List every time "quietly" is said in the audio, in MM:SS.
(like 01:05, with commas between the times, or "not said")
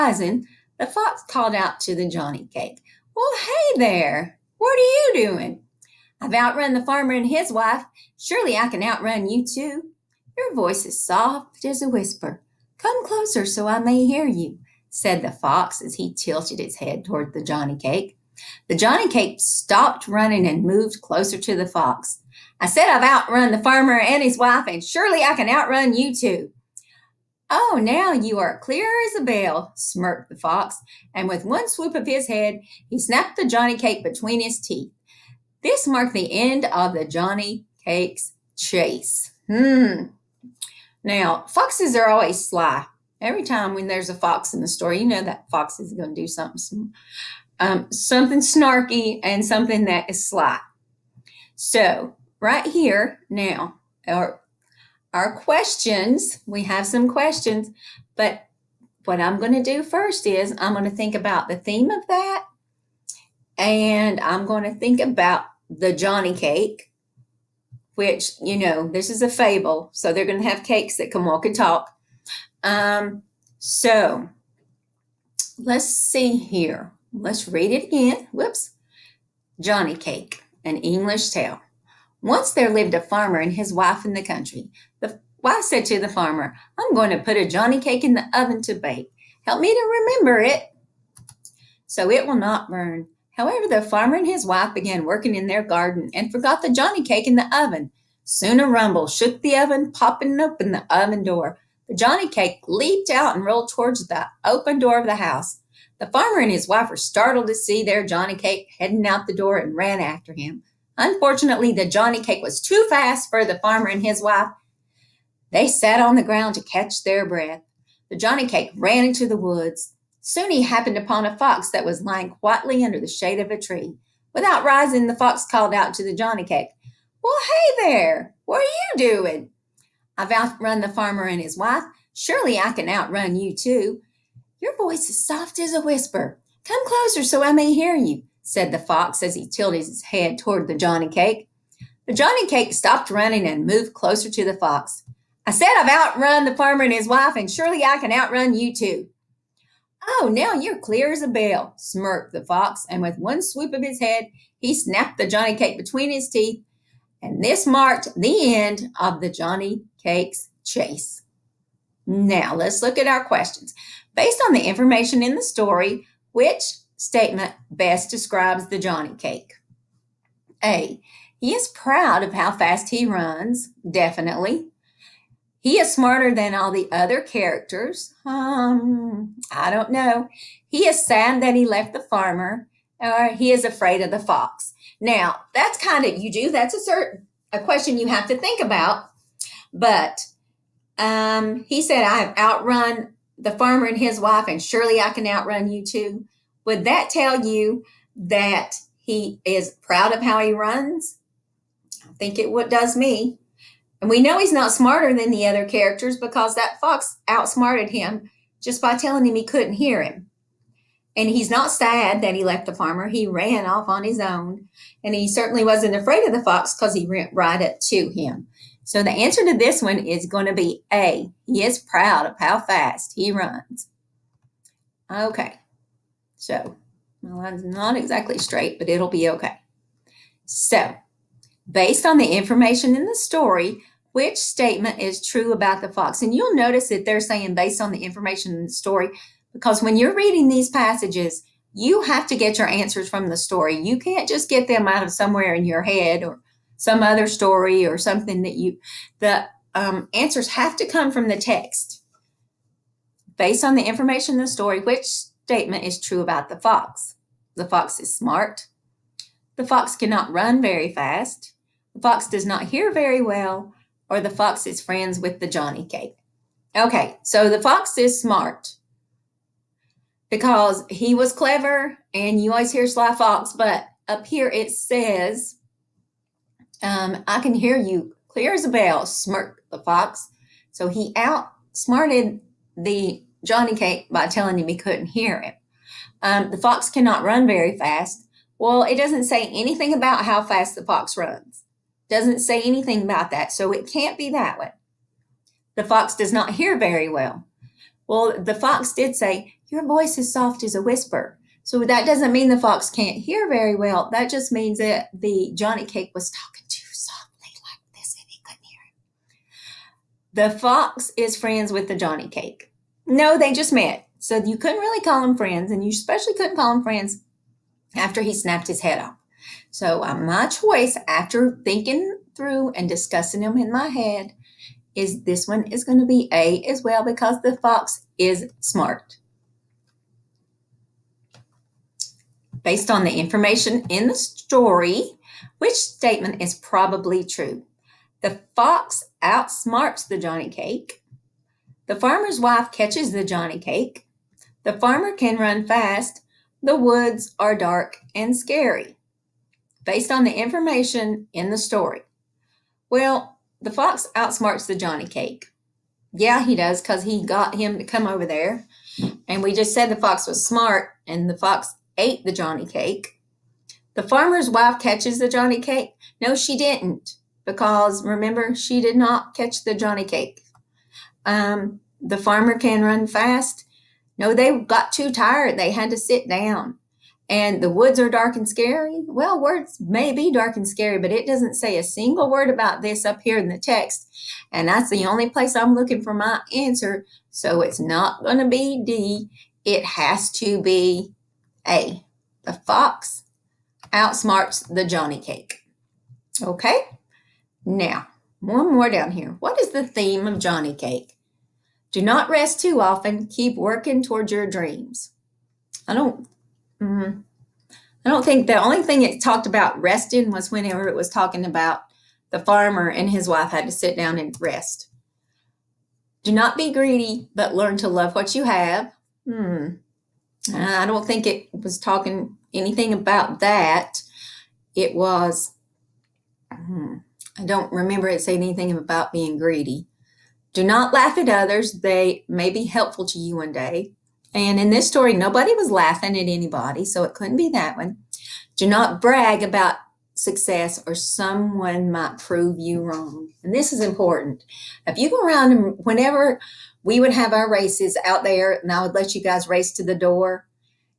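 02:02.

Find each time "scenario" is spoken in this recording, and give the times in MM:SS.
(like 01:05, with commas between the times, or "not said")
not said.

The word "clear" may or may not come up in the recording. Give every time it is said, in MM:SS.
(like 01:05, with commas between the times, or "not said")
00:28, 02:30, 04:38.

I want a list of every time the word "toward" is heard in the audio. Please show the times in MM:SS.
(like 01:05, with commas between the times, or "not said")
00:17, 01:43, 02:20, 06:44.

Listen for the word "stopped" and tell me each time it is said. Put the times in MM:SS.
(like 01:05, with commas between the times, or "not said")
00:19, 02:22.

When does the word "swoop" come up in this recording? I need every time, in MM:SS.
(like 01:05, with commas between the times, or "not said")
00:31, 02:33.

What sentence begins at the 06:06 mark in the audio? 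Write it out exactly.
No, she didn't because remember, she did not catch the Johnny cake.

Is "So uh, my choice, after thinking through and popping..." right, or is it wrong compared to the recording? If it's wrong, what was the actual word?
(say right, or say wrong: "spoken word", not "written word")
wrong: "discussing", not "popping".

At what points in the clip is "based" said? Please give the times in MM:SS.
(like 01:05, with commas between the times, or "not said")
02:44, 03:51, 03:57, 04:13, 05:32, 05:49.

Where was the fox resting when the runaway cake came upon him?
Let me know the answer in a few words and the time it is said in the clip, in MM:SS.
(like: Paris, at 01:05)
Under the shade of a tree, at 02:02.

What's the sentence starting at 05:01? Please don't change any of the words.
So that doesn't mean the fox can't hear very well.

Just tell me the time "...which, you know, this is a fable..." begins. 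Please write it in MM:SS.
01:07.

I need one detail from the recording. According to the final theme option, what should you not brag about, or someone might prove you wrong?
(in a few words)
Success.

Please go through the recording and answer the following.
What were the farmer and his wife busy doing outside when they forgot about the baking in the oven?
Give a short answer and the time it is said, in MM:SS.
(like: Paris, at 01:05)
Working in their garden, at 01:35.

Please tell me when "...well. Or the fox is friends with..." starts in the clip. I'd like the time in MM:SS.
04:23.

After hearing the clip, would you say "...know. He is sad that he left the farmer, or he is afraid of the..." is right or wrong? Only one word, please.
right.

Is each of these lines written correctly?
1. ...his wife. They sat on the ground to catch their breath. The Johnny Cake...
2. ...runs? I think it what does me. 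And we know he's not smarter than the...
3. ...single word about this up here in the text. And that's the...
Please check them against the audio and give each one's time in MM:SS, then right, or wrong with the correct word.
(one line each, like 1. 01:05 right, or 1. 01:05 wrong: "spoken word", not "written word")
1. 01:54 right
2. 03:20 right
3. 06:21 right.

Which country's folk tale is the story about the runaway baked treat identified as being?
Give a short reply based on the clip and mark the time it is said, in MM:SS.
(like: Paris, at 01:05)
English, at 01:20.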